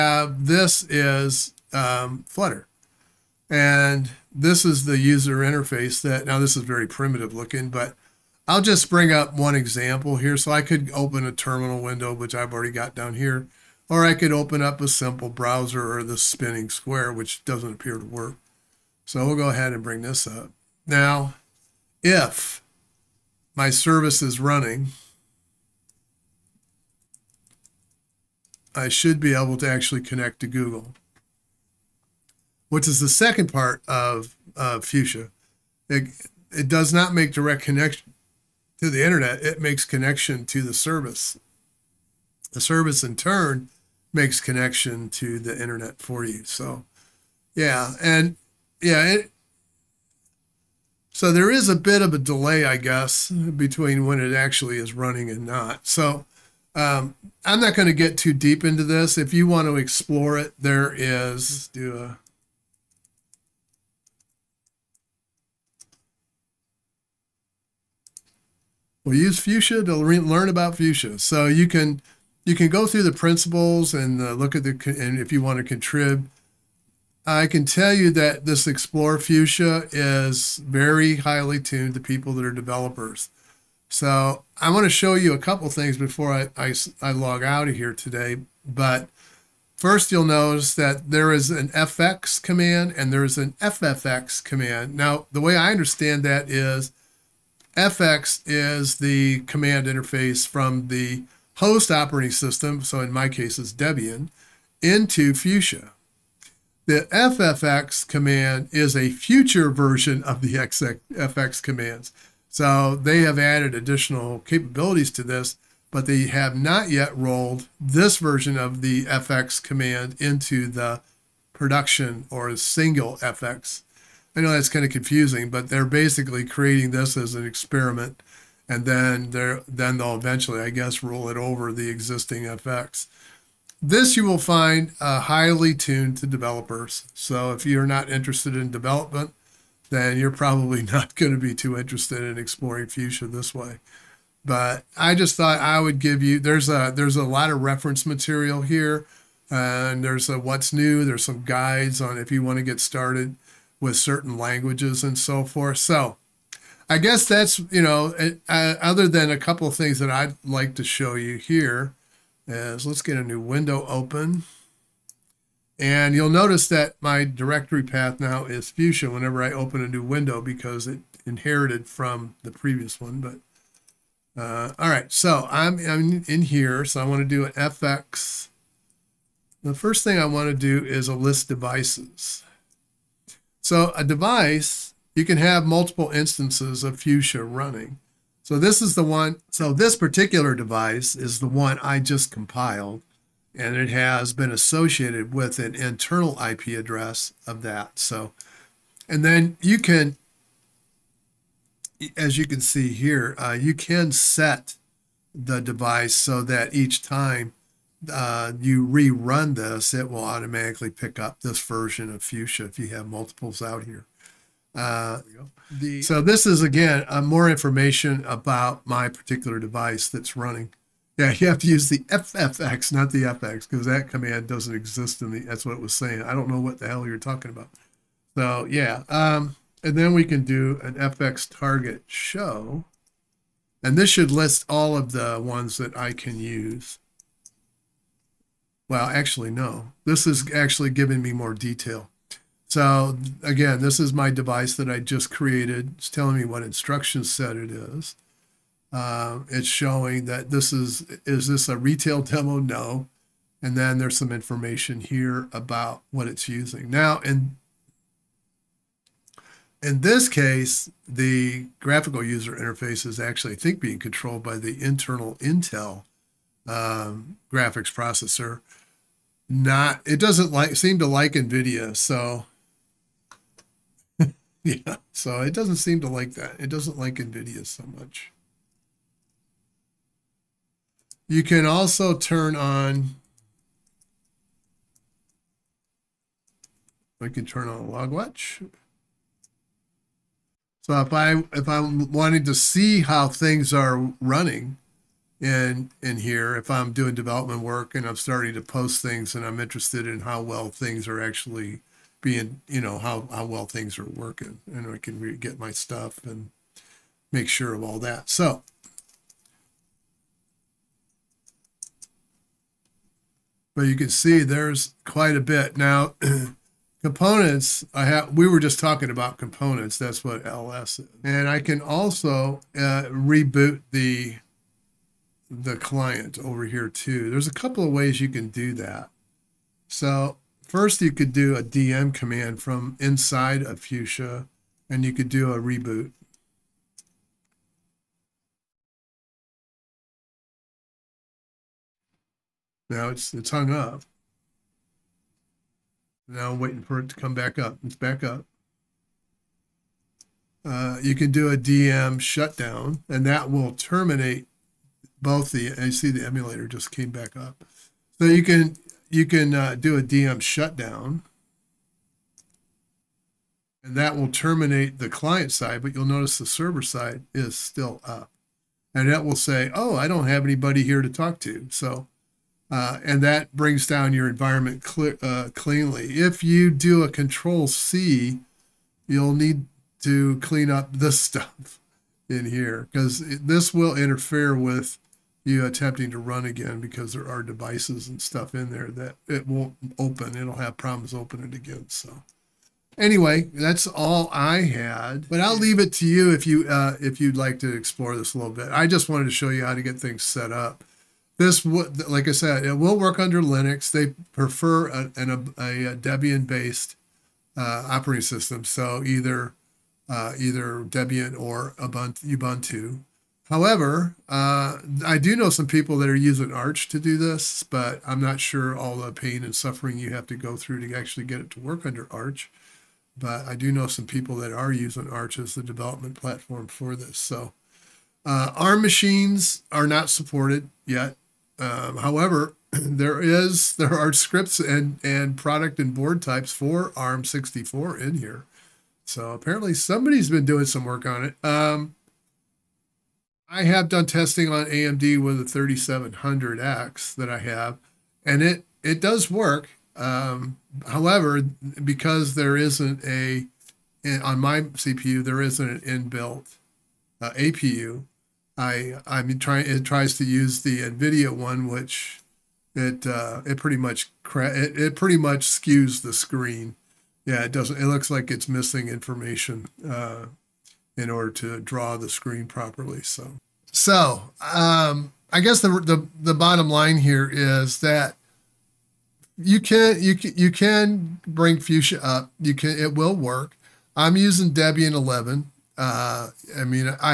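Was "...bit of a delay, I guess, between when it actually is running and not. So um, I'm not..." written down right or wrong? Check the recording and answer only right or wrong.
right.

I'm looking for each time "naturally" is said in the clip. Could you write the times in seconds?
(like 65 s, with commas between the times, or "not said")
not said.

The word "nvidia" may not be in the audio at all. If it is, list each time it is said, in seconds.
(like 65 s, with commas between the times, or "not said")
271 s, 277 s, 460 s.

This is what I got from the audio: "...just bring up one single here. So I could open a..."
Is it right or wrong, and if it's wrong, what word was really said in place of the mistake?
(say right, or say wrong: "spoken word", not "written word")
wrong: "example", not "single".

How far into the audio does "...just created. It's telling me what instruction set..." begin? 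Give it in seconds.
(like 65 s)
244 s.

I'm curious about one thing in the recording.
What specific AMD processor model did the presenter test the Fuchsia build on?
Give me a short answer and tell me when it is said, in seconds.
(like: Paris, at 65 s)
3700X, at 445 s.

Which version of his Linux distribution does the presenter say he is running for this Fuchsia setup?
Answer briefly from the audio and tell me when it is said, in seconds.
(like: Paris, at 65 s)
Debian 11, at 484 s.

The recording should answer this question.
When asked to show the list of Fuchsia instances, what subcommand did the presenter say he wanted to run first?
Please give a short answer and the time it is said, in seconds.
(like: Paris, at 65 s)
list devices, at 181 s.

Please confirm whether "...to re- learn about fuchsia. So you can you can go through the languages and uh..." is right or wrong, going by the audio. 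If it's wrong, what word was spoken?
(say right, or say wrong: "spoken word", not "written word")
wrong: "principles", not "languages".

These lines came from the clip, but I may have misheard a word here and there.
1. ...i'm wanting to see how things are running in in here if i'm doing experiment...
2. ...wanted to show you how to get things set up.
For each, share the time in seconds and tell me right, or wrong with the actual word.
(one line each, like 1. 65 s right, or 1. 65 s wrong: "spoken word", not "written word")
1. 291 s wrong: "development", not "experiment"
2. 399 s right.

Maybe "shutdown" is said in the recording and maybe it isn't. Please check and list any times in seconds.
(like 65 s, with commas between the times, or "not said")
352 s, 360 s.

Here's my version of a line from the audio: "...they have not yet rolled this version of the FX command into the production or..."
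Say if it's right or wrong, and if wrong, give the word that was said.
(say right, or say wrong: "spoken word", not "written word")
right.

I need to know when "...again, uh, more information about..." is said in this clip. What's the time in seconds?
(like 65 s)
216 s.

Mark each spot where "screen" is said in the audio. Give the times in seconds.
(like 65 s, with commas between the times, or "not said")
466 s, 472 s.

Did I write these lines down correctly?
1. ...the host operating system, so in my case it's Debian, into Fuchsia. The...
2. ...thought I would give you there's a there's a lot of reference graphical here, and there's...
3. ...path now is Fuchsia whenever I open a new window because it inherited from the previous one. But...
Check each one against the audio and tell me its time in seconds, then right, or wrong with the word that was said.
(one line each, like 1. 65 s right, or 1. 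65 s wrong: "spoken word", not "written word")
1. 100 s right
2. 145 s wrong: "material", not "graphical"
3. 167 s right.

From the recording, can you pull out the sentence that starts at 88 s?
But first you'll notice that there is an FX command and there is an FFX command.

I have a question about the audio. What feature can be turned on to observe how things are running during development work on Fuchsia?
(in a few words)
log watch.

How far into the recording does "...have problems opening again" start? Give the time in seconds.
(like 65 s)
390 s.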